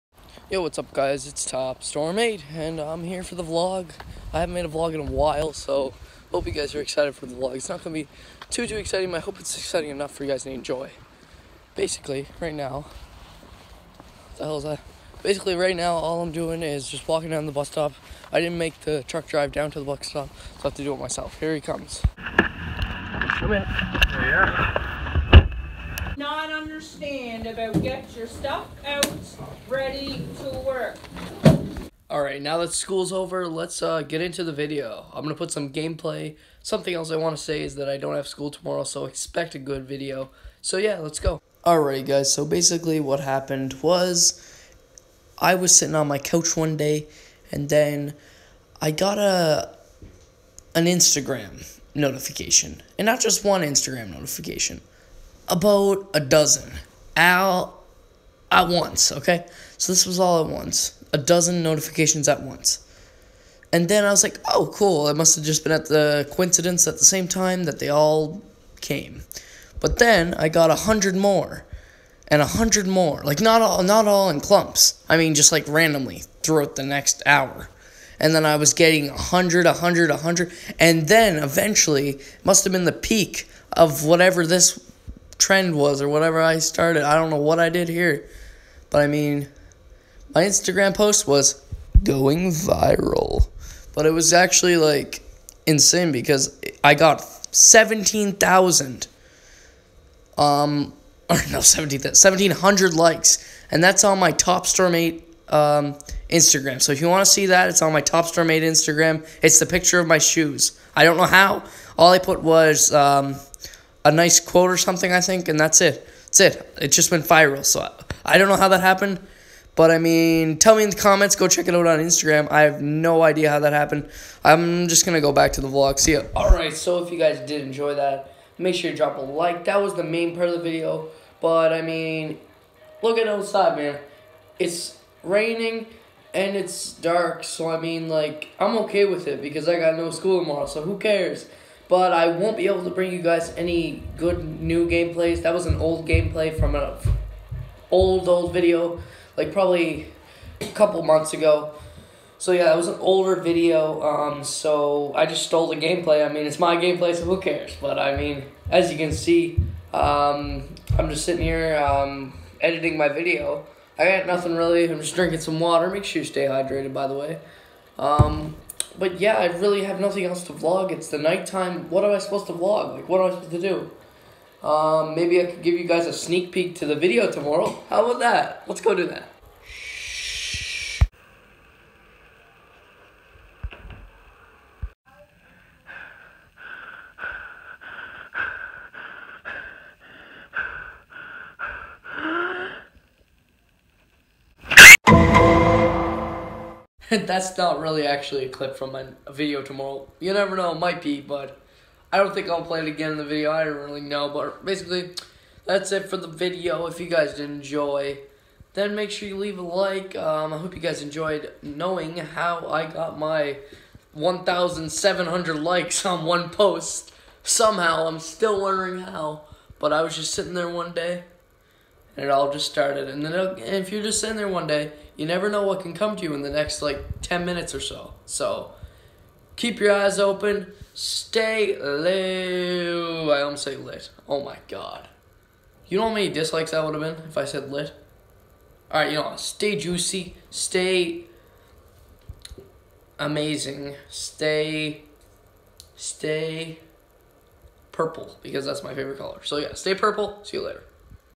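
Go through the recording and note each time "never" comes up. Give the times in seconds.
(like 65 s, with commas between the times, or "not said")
200 s, 225 s.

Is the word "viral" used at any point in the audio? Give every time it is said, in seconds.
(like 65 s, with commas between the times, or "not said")
92 s, 117 s.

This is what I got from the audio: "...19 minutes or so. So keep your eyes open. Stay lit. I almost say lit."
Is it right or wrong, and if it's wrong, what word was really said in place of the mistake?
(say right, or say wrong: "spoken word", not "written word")
wrong: "10", not "19".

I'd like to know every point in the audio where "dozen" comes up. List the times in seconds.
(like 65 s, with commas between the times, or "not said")
56 s, 61 s.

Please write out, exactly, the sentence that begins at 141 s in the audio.
but I won't be able to bring you guys any good new gameplays.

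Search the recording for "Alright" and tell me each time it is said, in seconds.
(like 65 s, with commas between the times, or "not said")
41 s, 238 s.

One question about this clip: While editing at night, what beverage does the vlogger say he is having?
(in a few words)
water.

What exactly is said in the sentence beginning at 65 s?
It must have just been at the coincidence at the same time that they all came.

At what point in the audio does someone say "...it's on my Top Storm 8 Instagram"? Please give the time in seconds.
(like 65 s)
107 s.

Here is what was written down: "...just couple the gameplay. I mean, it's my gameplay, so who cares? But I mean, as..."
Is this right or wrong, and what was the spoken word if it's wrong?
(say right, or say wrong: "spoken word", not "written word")
wrong: "stole", not "couple".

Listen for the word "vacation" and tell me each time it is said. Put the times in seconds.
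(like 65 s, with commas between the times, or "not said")
not said.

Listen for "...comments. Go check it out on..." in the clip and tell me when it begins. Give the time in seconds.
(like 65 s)
120 s.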